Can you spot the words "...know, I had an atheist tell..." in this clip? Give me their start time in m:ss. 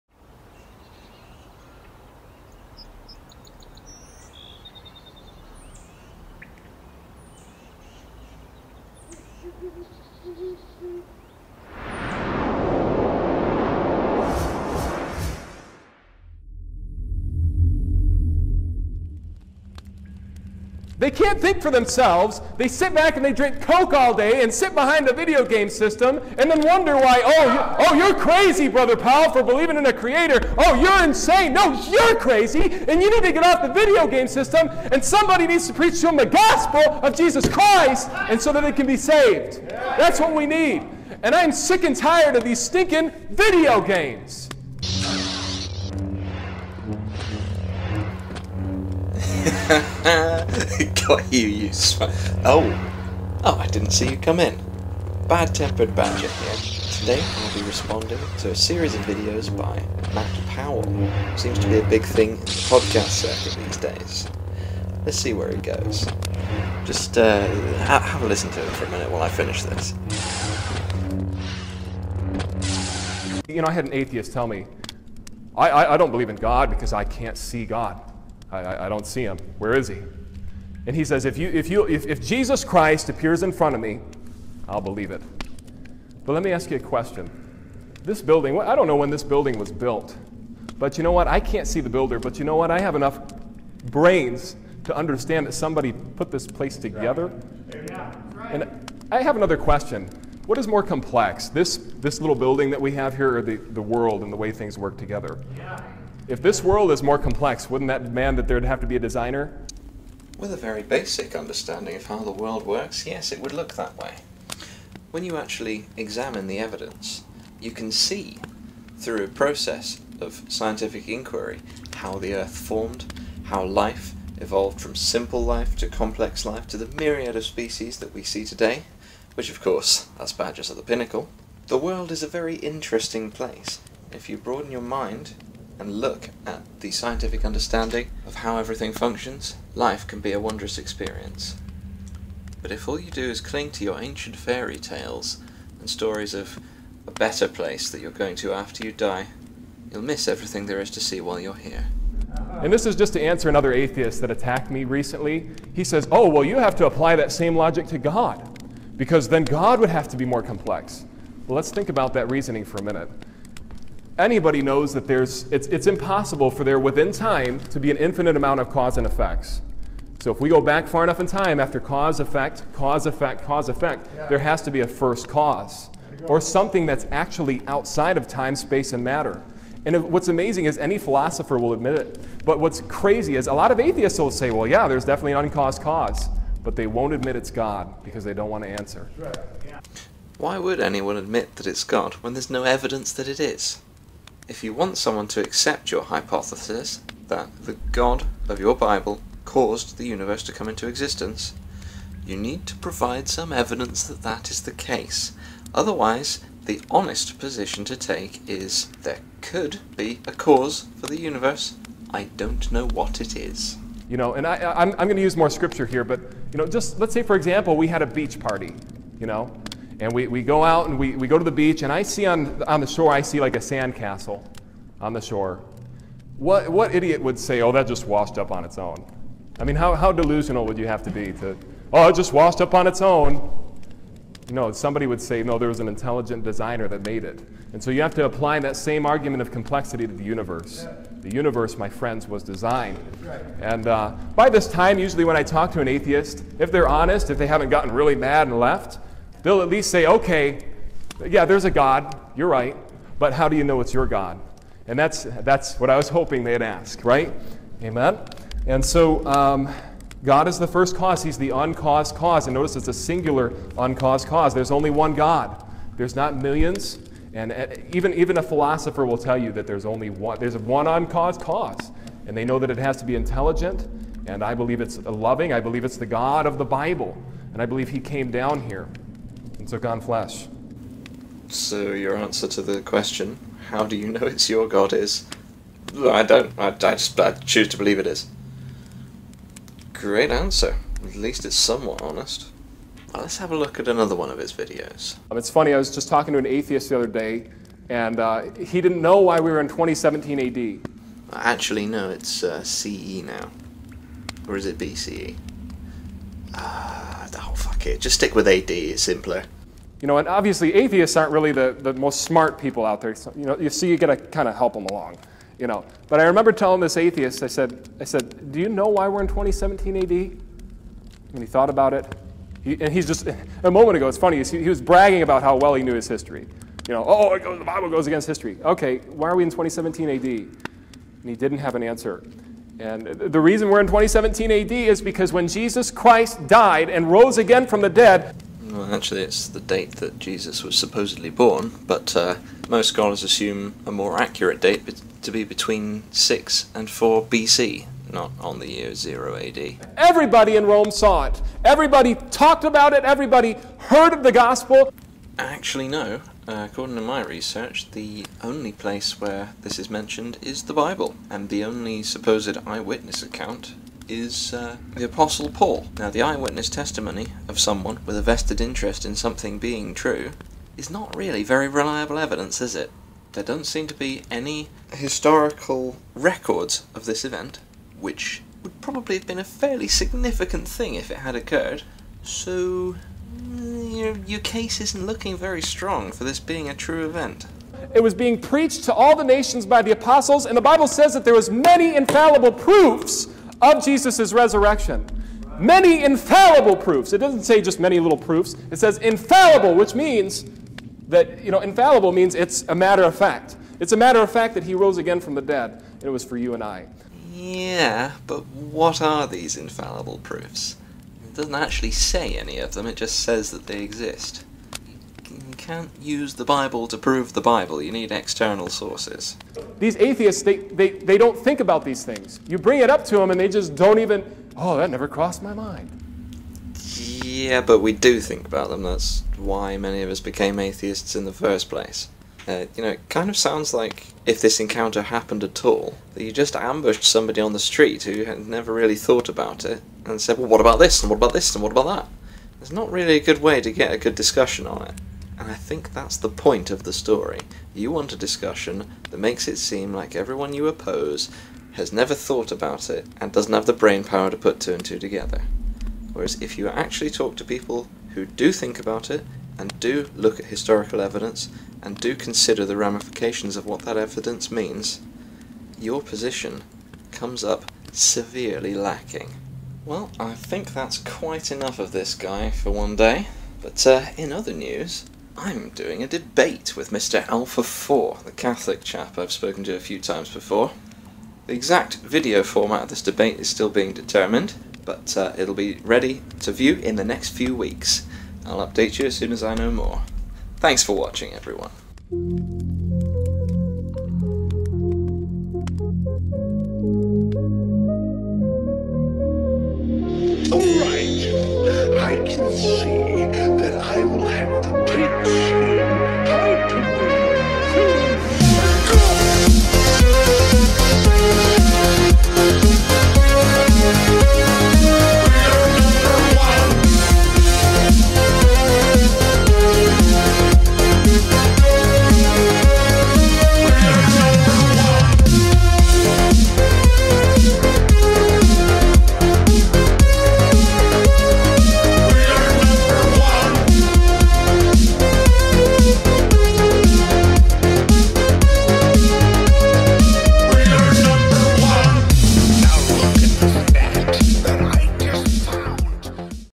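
1:13.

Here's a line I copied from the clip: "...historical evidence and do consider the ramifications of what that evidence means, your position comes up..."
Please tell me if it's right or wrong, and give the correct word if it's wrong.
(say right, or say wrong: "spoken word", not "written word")
right.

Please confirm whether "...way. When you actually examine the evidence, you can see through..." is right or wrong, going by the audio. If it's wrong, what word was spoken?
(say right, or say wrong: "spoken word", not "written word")
right.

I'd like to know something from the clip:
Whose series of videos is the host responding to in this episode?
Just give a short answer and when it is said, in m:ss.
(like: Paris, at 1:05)
Matt Powell, at 1:00.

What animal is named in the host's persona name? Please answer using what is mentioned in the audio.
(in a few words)
Badger.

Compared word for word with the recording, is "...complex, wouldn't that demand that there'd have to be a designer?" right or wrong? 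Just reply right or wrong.
right.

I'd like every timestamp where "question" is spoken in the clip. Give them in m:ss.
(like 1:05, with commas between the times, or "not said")
1:26, 1:39, 4:42.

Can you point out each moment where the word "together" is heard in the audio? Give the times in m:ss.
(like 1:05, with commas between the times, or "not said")
1:36, 1:44, 7:34.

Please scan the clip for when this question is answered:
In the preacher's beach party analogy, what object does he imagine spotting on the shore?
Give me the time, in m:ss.
3:43.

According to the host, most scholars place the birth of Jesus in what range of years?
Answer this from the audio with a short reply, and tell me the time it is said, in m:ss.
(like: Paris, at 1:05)
6 and 4 BC, at 5:46.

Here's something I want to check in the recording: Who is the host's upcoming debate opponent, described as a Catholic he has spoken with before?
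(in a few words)
Mr. Alpha 4.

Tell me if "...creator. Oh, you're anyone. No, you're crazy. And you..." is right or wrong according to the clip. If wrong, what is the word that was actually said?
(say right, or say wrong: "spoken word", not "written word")
wrong: "insane", not "anyone".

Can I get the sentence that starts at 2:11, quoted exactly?
The world is a very interesting place.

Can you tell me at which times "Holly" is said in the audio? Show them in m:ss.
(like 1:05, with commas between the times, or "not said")
not said.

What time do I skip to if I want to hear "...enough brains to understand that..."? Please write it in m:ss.
1:32.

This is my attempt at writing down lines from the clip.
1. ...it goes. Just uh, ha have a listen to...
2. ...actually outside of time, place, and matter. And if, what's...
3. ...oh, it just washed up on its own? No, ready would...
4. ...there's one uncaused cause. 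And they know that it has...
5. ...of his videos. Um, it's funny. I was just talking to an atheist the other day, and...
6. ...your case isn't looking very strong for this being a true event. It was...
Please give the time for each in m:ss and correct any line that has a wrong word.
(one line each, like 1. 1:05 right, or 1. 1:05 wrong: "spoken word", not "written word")
1. 1:05 right
2. 2:57 wrong: "space", not "place"
3. 3:51 wrong: "somebody", not "ready"
4. 4:30 right
5. 4:54 right
6. 6:24 right.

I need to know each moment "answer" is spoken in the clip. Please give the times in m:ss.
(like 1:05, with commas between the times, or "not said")
2:33, 3:08, 4:42, 4:50, 5:31.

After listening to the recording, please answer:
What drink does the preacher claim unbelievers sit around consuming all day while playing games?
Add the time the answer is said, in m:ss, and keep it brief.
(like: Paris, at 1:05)
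Coke, at 0:23.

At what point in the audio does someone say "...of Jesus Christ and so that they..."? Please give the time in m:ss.
0:37.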